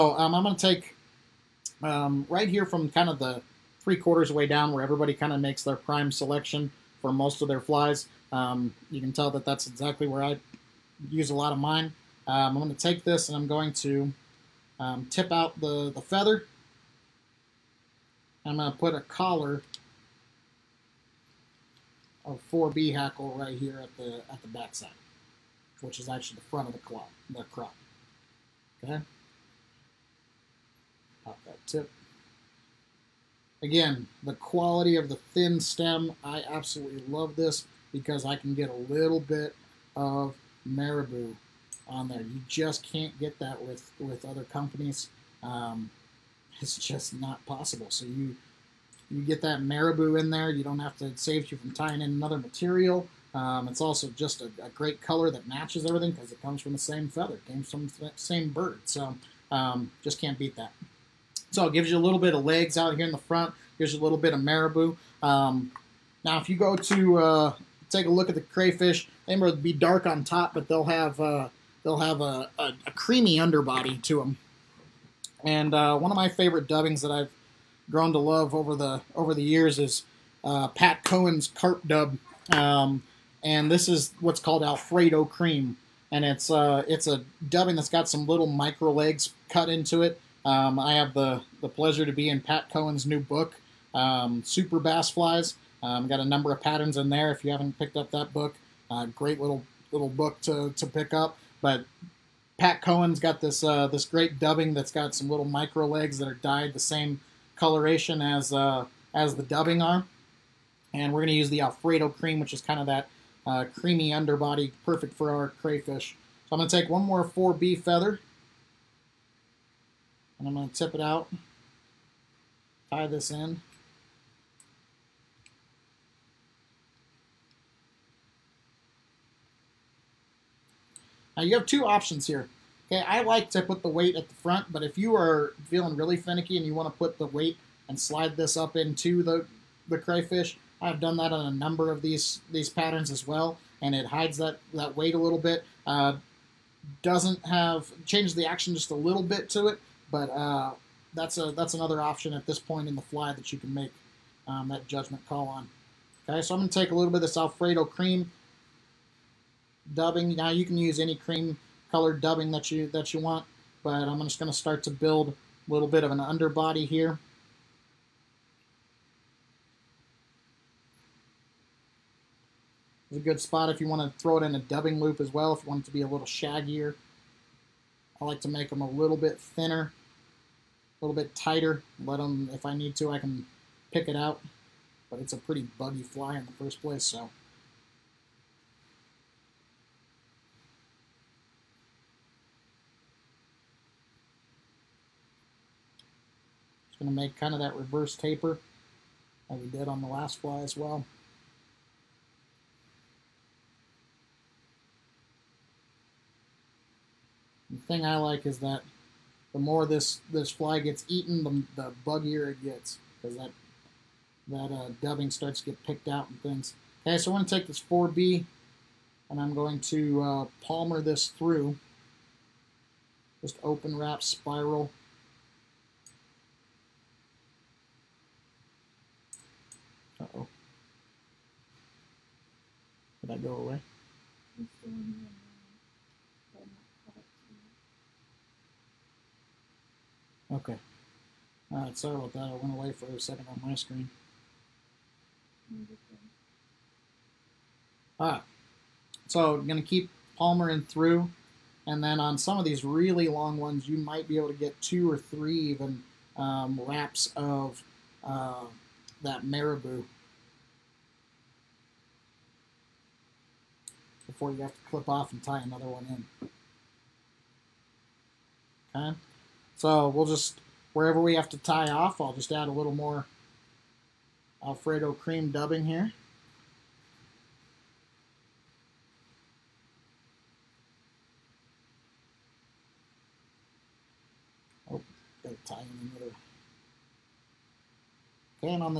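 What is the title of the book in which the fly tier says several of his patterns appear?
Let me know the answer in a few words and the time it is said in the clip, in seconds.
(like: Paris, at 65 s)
Super Bass Flies, at 94 s.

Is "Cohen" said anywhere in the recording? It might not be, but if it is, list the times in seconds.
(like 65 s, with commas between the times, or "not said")
81 s, 92 s, 102 s.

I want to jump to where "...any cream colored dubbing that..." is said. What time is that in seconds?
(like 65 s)
160 s.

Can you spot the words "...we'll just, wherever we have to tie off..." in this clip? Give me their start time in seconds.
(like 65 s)
270 s.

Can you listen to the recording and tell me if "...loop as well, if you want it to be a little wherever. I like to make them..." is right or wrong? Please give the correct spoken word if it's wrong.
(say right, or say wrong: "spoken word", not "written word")
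wrong: "shaggier", not "wherever".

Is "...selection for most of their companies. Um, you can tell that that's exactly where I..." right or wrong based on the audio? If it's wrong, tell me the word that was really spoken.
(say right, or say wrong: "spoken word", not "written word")
wrong: "flies", not "companies".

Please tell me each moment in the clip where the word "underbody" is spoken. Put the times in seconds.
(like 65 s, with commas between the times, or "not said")
73 s, 114 s, 166 s.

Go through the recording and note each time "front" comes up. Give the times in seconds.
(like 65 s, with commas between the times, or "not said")
26 s, 63 s, 134 s.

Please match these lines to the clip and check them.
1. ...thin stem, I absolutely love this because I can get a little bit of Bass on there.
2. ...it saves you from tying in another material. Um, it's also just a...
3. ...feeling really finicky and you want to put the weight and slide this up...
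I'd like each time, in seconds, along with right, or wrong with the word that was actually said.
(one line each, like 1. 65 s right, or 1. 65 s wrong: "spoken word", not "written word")
1. 35 s wrong: "Marabou", not "Bass"
2. 51 s right
3. 135 s right.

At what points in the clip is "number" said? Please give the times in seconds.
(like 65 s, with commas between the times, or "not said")
96 s, 141 s.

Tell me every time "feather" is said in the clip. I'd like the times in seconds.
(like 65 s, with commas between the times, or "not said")
16 s, 57 s, 117 s.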